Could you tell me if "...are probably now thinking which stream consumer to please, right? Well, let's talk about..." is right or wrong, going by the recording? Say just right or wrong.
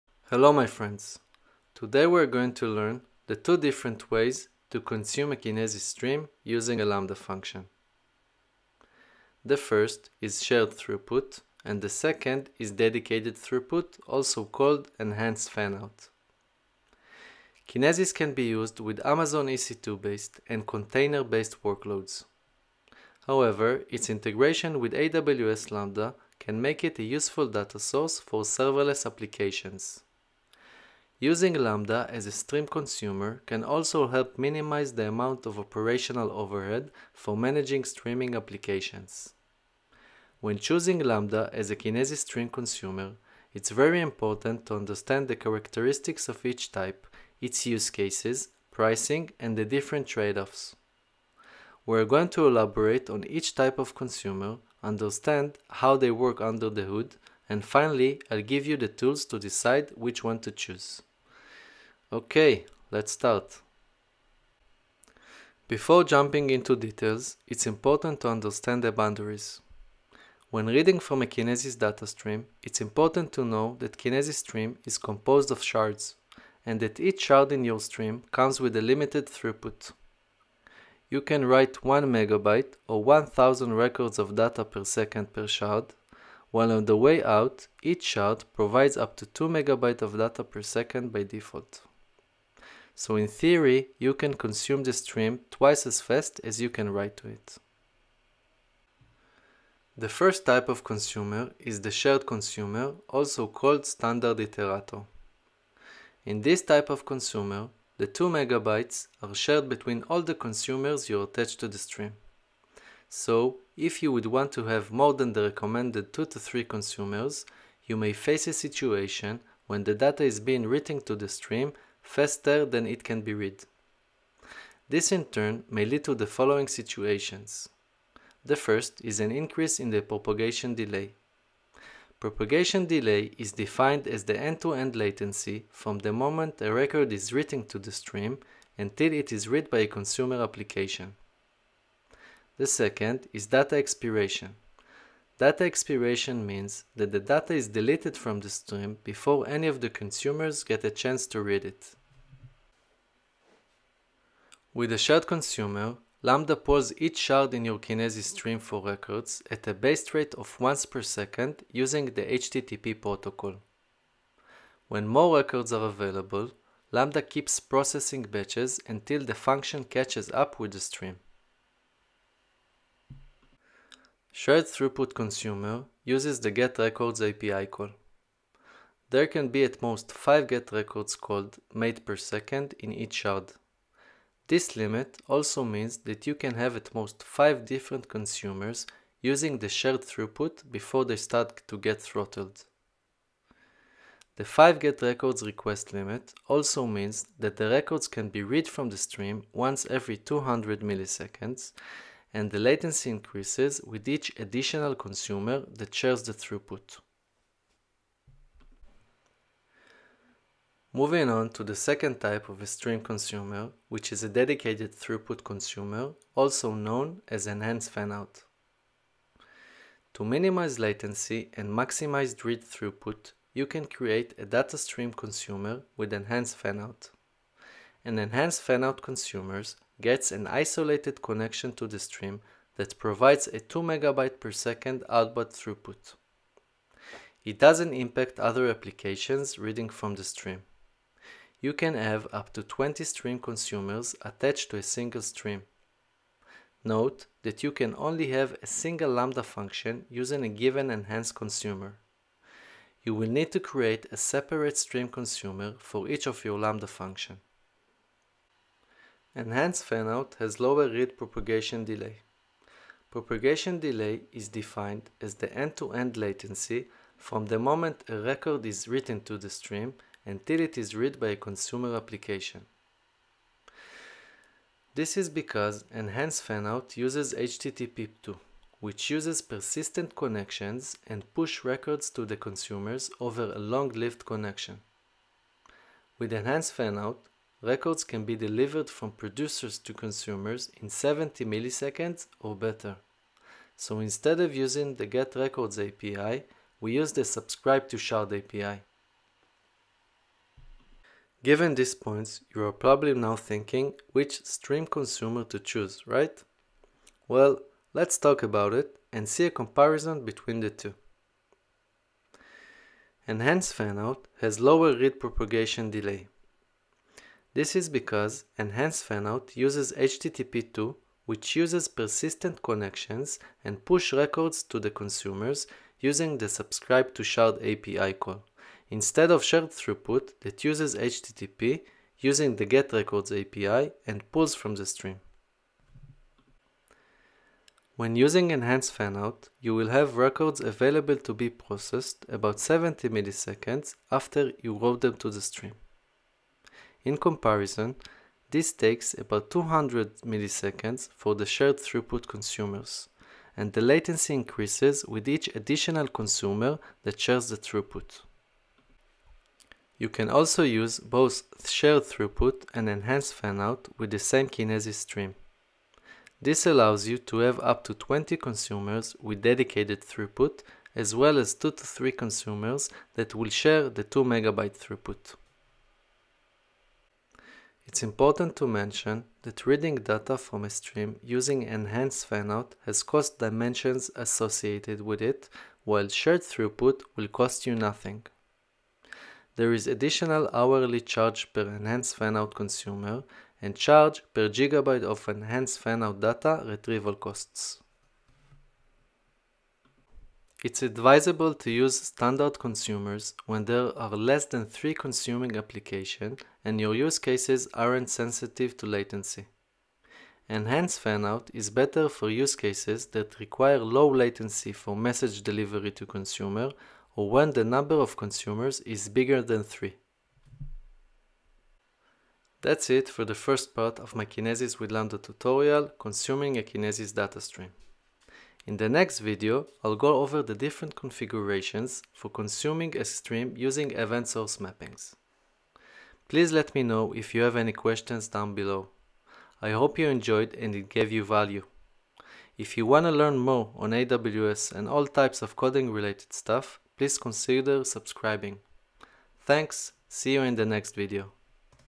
wrong.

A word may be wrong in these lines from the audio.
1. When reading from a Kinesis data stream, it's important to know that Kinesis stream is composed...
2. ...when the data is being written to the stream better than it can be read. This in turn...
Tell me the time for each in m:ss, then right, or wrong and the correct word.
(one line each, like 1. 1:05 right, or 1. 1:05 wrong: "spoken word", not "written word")
1. 1:10 right
2. 1:59 wrong: "faster", not "better".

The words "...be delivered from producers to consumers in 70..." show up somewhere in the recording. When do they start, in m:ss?
4:48.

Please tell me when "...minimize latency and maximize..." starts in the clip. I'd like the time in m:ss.
3:40.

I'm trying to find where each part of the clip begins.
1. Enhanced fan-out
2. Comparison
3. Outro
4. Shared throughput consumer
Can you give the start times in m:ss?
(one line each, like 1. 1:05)
1. 3:30
2. 5:01
3. 7:01
4. 1:39.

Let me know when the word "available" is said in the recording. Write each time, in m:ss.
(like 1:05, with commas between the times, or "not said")
2:45, 5:40.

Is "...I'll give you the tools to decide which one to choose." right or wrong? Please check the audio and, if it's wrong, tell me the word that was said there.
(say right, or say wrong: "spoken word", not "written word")
right.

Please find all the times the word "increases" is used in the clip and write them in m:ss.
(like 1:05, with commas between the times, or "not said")
2:09, 3:23, 5:54.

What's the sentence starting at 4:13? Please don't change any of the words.
You will need to create a separate stream consumer for each of your Lambda function.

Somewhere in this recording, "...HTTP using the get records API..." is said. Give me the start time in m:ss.
5:30.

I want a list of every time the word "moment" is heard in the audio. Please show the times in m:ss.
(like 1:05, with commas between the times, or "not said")
2:16, 4:27.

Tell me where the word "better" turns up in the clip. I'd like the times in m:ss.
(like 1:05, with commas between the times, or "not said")
4:52, 6:51.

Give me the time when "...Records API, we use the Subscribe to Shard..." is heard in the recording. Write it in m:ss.
4:55.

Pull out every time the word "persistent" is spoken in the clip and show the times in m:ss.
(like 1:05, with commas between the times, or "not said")
4:39, 5:21.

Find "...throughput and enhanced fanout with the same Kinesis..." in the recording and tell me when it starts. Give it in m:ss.
6:02.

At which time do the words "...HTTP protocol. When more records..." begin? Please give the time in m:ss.
2:42.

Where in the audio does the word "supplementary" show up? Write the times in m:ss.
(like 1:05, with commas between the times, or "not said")
not said.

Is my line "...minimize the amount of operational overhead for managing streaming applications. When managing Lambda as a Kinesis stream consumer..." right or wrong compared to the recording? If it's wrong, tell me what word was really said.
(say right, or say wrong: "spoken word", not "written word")
wrong: "choosing", not "managing".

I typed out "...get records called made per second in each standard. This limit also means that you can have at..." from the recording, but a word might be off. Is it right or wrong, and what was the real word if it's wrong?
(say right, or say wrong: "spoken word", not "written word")
wrong: "shard", not "standard".